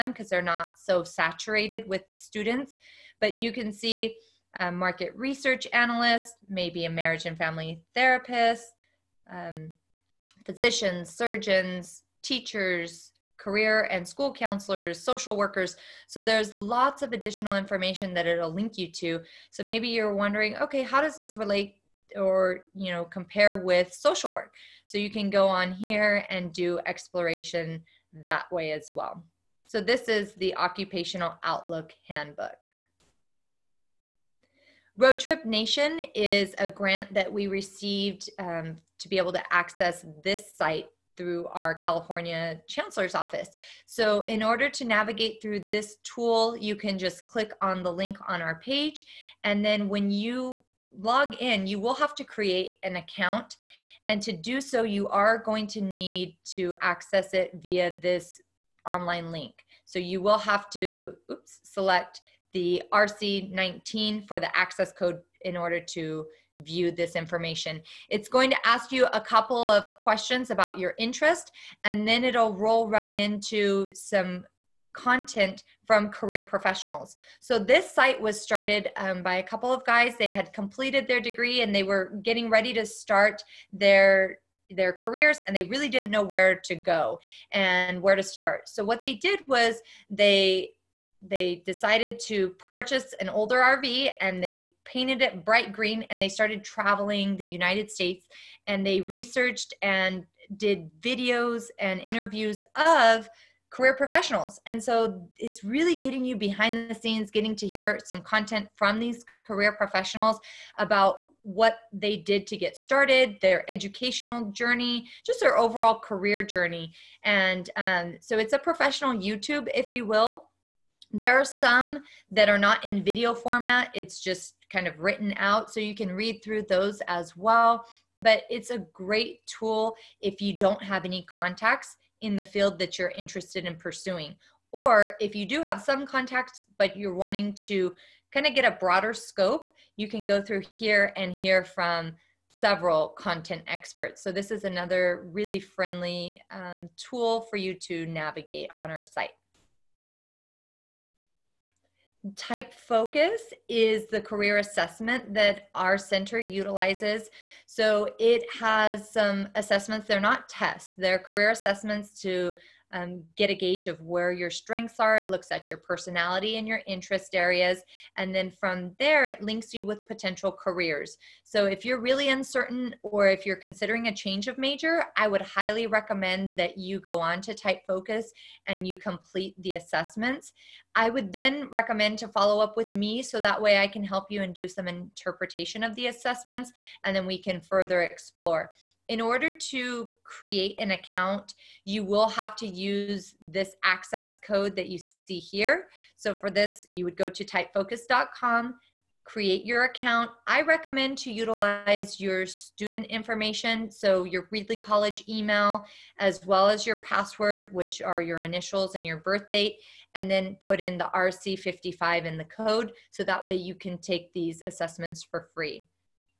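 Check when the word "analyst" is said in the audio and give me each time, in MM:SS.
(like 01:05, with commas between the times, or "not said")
00:05.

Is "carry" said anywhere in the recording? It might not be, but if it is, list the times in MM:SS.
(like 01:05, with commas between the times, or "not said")
not said.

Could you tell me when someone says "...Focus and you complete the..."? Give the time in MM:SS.
02:57.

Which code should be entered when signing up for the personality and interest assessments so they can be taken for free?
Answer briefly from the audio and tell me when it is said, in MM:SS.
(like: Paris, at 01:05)
RC55, at 03:31.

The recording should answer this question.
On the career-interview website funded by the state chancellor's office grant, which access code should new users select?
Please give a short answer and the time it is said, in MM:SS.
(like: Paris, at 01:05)
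RC19, at 01:02.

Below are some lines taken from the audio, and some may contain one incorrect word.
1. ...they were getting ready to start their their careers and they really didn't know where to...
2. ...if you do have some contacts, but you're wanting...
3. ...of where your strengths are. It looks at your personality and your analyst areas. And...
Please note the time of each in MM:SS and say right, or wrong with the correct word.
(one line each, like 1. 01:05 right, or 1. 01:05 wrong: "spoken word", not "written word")
1. 01:21 right
2. 02:15 right
3. 02:43 wrong: "interest", not "analyst".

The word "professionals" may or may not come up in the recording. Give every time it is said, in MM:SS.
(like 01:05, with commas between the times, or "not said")
01:16, 01:43, 01:49, 01:58.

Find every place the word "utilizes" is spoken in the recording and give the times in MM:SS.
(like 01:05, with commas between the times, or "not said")
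02:36, 03:21.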